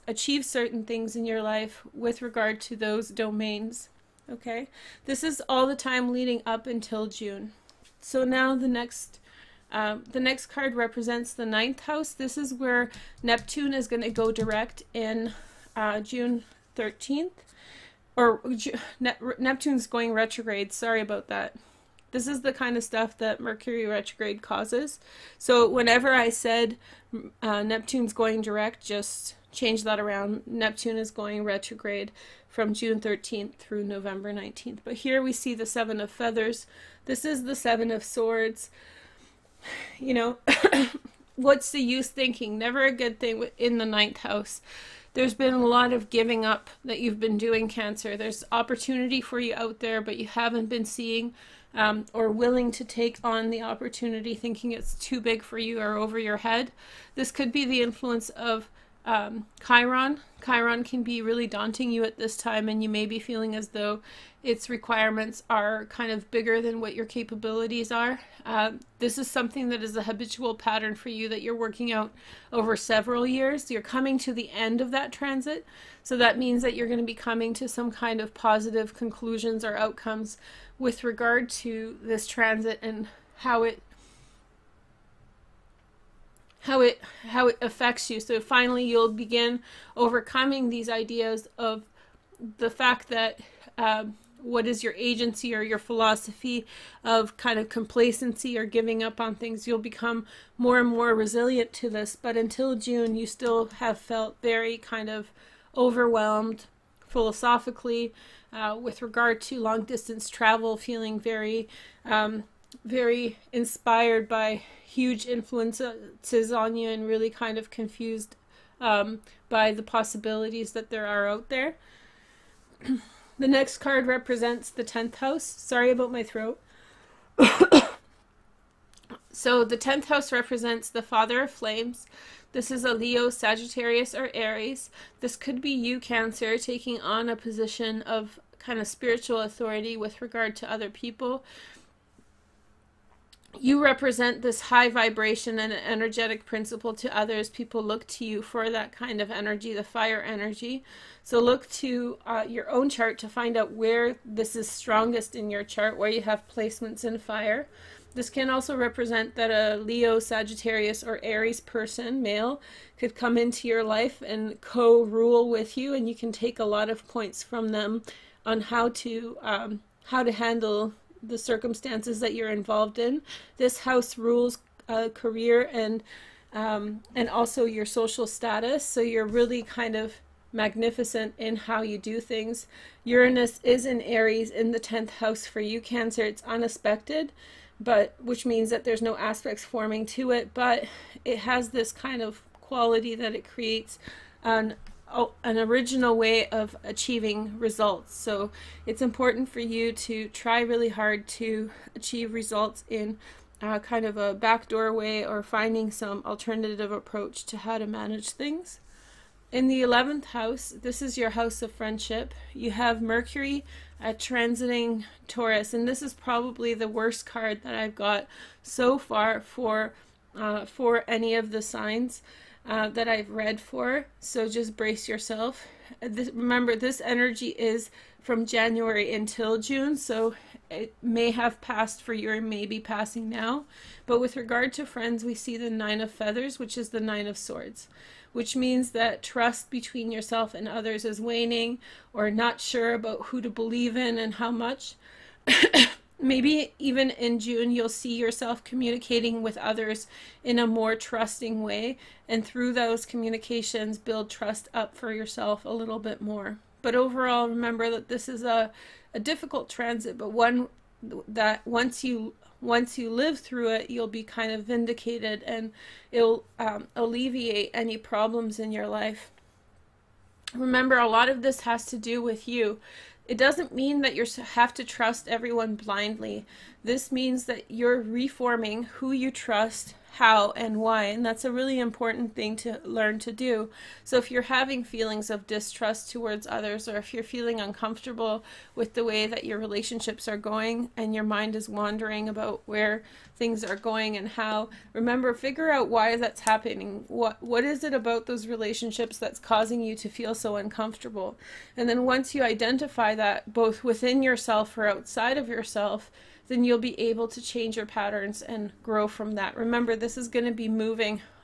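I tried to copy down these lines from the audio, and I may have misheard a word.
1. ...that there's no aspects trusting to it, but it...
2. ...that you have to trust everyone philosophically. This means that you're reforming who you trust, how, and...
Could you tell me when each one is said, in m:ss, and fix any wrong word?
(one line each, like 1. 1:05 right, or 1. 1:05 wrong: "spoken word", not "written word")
1. 3:08 wrong: "forming", not "trusting"
2. 4:34 wrong: "blindly", not "philosophically".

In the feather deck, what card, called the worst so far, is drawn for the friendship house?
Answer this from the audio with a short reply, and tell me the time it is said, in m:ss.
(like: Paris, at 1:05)
Nine of Feathers, at 3:55.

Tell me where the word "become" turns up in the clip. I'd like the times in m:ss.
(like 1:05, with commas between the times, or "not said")
1:39.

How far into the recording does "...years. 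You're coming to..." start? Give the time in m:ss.
1:13.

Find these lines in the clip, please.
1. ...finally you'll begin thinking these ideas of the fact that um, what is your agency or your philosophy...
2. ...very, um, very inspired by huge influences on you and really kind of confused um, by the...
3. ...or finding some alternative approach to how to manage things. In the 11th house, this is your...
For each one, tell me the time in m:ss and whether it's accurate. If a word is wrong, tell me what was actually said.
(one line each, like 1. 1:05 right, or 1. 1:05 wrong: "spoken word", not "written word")
1. 1:28 wrong: "overcoming", not "thinking"
2. 1:51 right
3. 3:25 right.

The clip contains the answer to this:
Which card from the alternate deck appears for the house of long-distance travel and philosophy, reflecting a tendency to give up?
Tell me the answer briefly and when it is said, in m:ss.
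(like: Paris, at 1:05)
Seven of Feathers, at 0:35.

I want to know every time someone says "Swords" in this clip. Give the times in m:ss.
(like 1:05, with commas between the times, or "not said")
0:38, 3:57.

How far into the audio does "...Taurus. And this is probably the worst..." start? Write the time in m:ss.
3:35.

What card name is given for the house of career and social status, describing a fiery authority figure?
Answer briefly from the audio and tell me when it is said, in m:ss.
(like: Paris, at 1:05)
Father of Flames, at 2:11.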